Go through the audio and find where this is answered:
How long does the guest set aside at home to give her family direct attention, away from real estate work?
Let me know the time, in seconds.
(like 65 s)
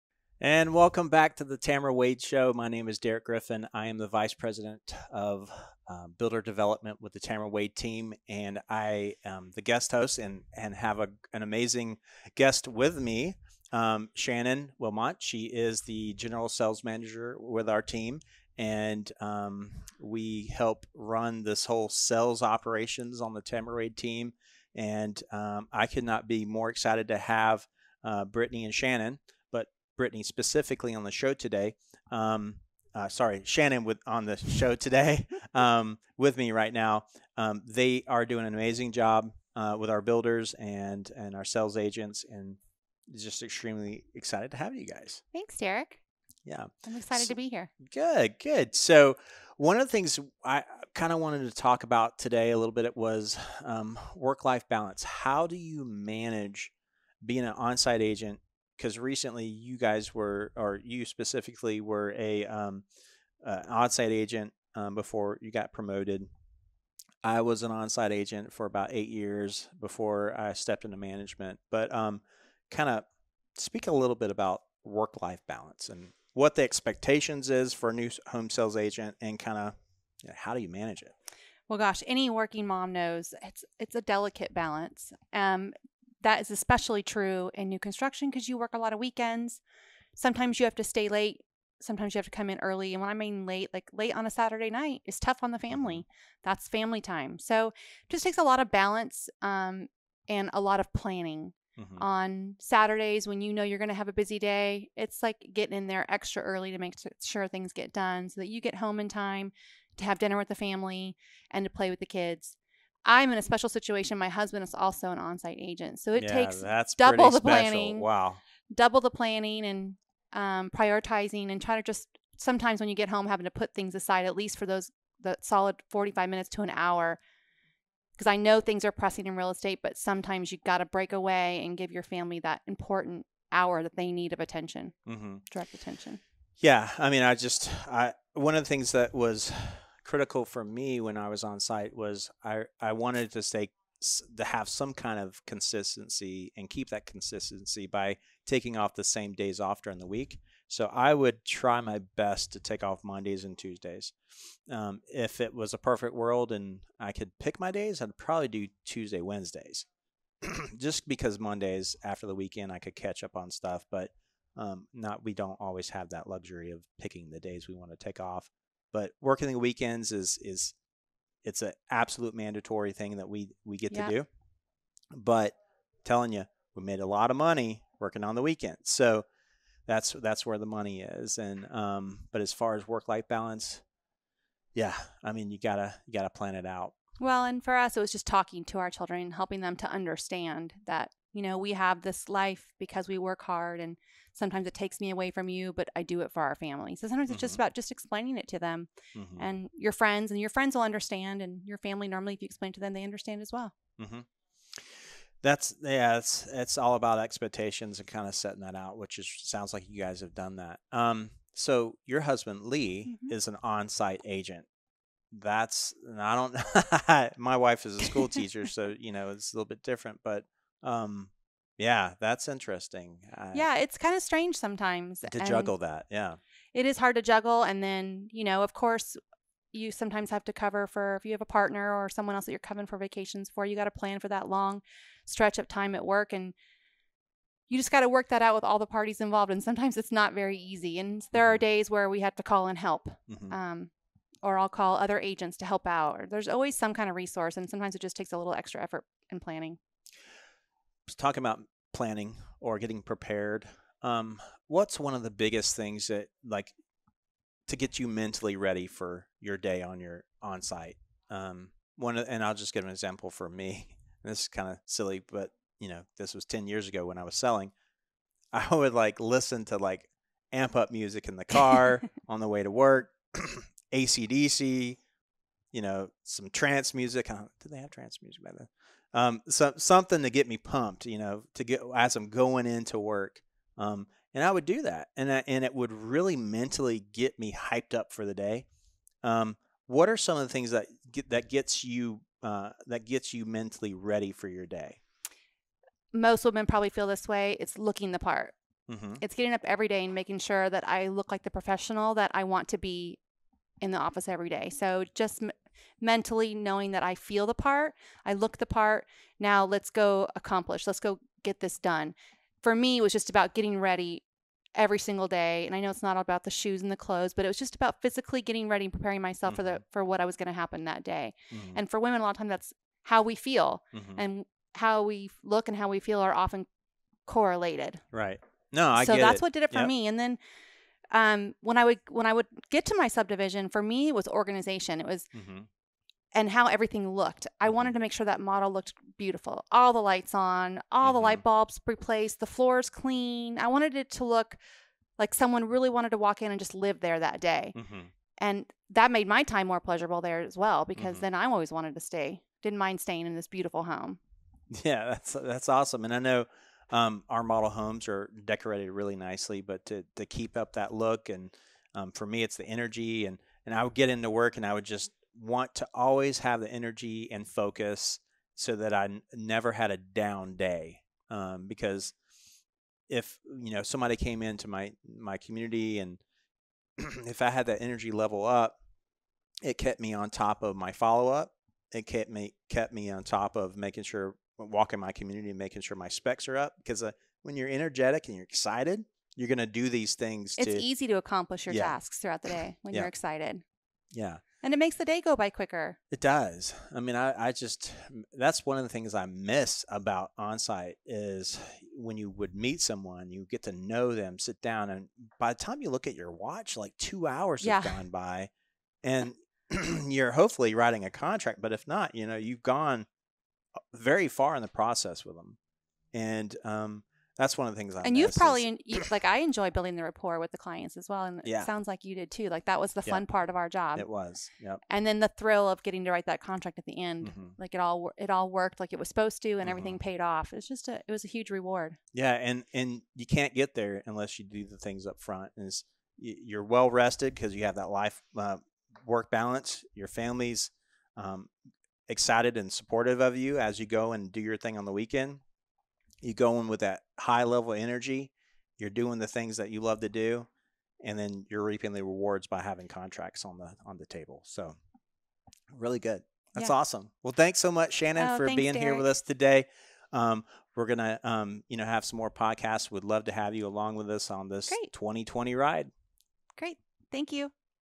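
125 s.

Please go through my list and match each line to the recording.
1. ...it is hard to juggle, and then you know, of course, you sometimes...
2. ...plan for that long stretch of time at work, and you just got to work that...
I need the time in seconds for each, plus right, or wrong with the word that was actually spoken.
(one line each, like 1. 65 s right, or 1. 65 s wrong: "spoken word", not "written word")
1. 226 s right
2. 233 s right.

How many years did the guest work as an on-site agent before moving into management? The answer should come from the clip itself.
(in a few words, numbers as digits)
8.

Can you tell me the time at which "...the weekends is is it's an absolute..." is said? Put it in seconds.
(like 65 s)
169 s.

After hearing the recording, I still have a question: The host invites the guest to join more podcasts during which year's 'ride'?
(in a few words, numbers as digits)
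2020.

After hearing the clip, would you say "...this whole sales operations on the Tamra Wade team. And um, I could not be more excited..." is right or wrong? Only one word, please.
right.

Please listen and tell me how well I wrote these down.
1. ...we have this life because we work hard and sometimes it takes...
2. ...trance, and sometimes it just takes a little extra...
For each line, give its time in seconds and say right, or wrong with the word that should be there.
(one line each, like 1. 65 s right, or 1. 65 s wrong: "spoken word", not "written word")
1. 191 s right
2. 247 s wrong: "resource", not "trance".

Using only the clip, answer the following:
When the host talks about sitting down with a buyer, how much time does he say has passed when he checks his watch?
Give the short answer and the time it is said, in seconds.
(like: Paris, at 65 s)
Two hours, at 406 s.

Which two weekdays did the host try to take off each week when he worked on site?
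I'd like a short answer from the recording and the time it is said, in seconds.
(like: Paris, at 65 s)
Mondays and Tuesdays, at 153 s.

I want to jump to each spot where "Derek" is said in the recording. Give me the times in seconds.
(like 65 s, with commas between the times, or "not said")
2 s, 45 s, 458 s.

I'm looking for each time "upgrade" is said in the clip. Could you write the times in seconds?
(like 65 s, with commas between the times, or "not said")
not said.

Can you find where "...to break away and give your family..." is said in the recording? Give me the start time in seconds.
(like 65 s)
130 s.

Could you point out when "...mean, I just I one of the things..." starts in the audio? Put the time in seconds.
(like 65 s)
137 s.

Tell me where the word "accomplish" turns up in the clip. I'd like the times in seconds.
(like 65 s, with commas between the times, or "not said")
310 s, 391 s.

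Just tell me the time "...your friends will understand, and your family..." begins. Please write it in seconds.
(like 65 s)
200 s.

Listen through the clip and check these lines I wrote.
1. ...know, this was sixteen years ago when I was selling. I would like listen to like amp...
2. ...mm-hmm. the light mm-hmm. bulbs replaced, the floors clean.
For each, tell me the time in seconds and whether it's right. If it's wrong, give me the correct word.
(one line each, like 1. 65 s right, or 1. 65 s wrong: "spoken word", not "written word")
1. 265 s wrong: "ten", not "sixteen"
2. 341 s right.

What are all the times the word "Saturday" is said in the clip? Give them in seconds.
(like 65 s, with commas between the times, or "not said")
94 s, 102 s.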